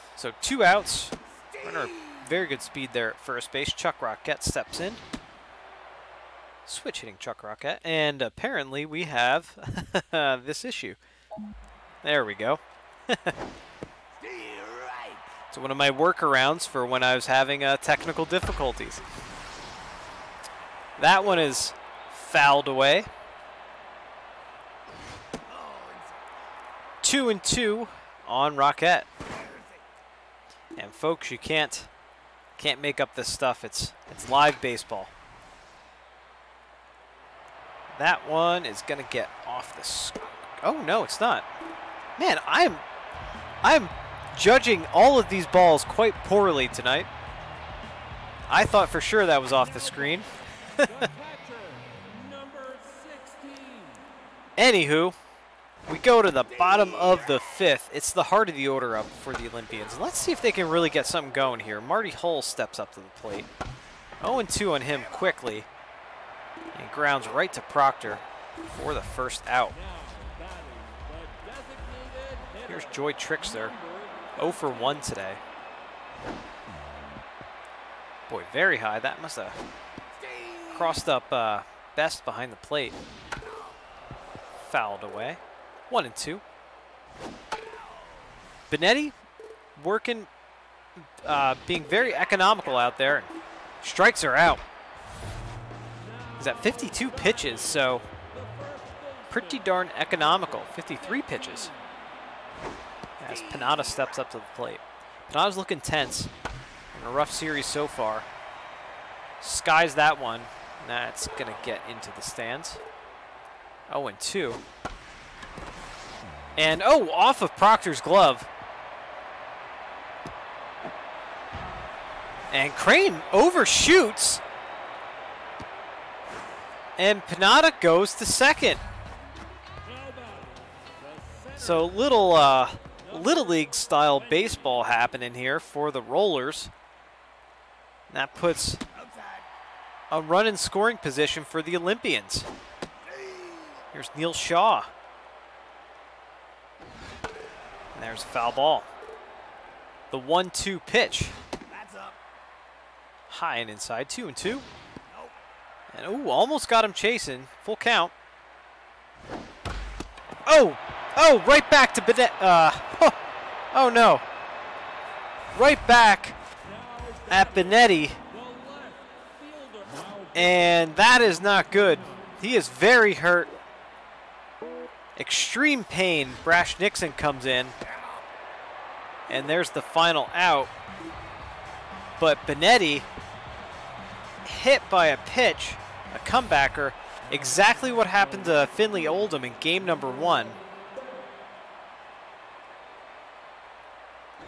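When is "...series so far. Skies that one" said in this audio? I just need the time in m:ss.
1:47.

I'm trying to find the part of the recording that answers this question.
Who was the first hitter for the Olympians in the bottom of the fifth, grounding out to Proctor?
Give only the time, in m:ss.
1:01.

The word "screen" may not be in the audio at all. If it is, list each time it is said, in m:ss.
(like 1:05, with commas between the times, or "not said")
0:49.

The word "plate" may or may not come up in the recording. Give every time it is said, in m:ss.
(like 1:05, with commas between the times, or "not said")
1:03, 1:22, 1:44.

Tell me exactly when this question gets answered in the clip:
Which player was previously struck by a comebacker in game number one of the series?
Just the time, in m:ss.
3:08.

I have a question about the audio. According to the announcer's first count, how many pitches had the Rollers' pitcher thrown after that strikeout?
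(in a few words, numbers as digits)
52.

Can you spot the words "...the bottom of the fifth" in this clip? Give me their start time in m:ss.
0:56.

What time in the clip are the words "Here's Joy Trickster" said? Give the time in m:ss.
1:12.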